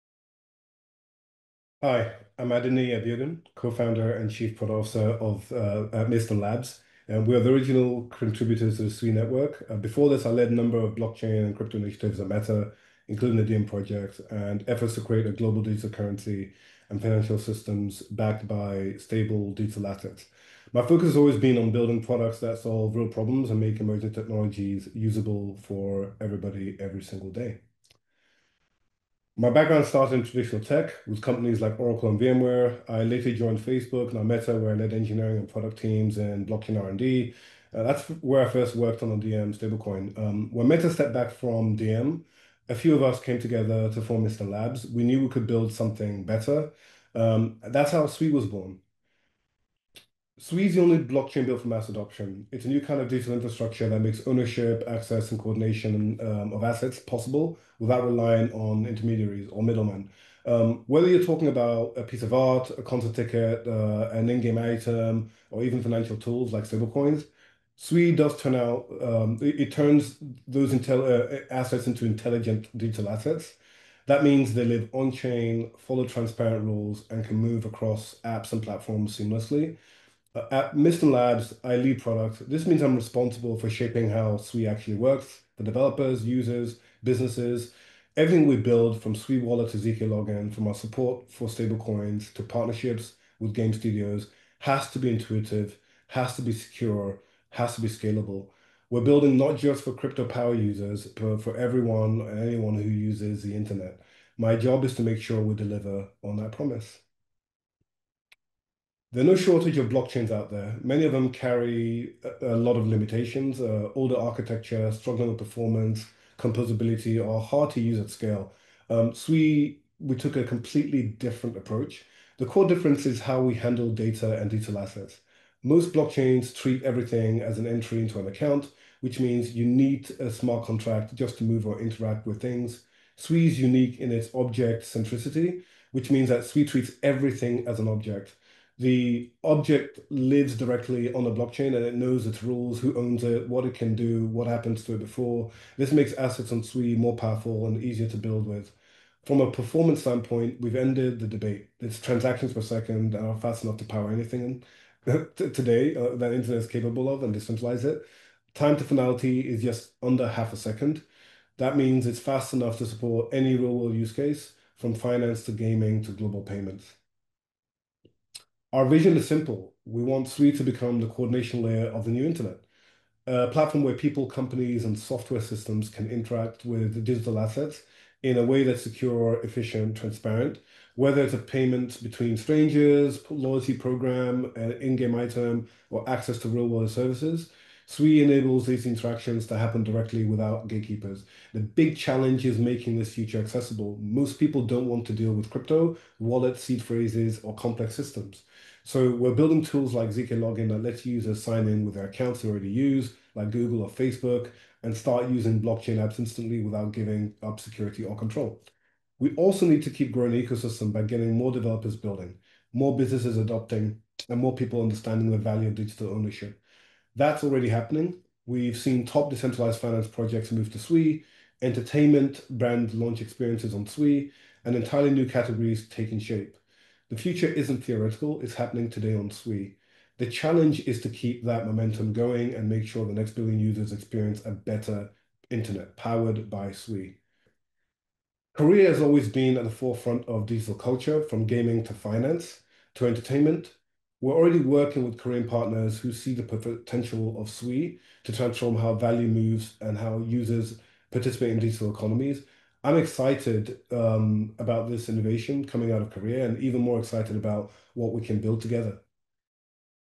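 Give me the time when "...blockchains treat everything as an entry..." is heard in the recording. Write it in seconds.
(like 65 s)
125 s.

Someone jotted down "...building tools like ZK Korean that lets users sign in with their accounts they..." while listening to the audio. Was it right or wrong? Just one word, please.
wrong.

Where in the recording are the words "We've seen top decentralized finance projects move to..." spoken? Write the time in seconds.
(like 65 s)
218 s.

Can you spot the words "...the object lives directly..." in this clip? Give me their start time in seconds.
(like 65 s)
138 s.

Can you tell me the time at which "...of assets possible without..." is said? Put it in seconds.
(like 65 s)
56 s.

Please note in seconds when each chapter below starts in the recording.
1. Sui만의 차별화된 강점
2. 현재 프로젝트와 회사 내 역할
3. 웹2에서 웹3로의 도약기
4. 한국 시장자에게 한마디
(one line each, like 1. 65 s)
1. 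107 s
2. 49 s
3. 28 s
4. 237 s.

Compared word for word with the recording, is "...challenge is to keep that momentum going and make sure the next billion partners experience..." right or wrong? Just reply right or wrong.
wrong.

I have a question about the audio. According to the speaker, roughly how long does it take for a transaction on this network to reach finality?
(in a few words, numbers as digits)
just under half a second.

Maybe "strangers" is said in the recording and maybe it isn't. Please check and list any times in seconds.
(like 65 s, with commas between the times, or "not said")
182 s.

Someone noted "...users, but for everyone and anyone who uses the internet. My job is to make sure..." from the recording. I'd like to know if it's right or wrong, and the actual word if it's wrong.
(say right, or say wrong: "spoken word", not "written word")
right.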